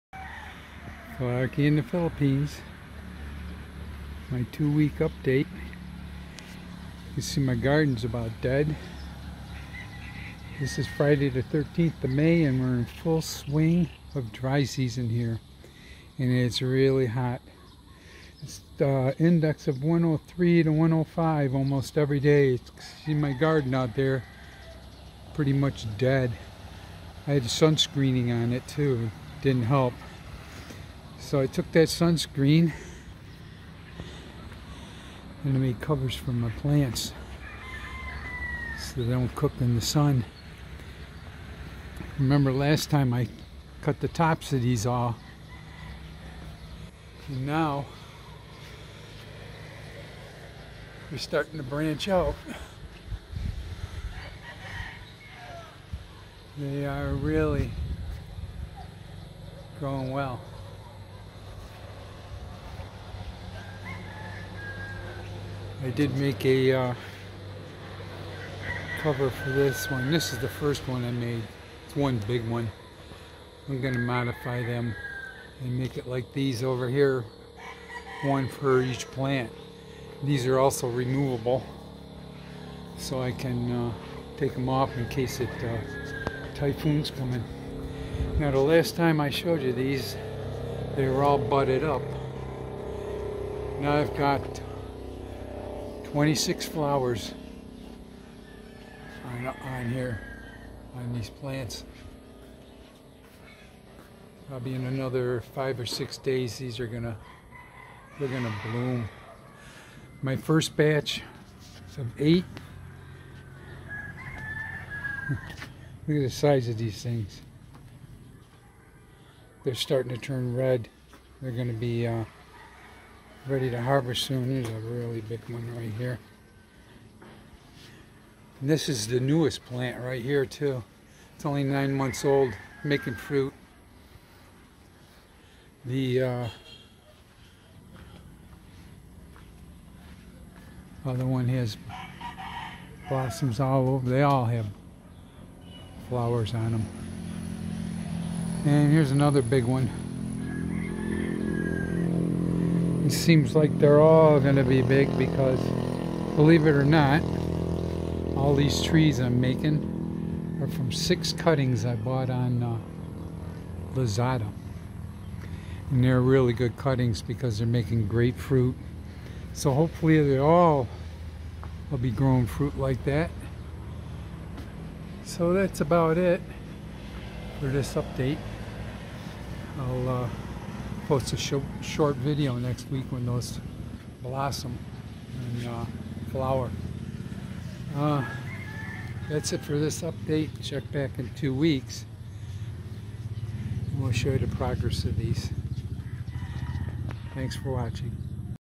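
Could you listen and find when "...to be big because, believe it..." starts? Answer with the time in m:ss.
2:34.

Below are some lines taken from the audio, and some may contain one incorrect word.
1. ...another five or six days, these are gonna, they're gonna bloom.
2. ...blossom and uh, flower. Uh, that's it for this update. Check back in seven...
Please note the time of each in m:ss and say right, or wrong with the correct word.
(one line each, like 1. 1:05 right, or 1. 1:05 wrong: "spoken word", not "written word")
1. 1:44 right
2. 3:04 wrong: "two", not "seven".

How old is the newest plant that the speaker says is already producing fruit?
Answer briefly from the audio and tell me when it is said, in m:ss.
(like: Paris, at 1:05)
9 months, at 2:11.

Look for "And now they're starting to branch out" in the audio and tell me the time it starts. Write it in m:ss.
0:47.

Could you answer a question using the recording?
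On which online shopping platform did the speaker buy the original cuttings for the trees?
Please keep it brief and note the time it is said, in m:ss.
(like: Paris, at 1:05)
Lazada, at 2:43.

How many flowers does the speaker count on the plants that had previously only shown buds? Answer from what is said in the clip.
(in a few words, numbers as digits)
26.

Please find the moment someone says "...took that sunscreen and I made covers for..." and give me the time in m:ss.
0:31.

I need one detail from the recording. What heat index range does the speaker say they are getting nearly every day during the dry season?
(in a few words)
103 to 105.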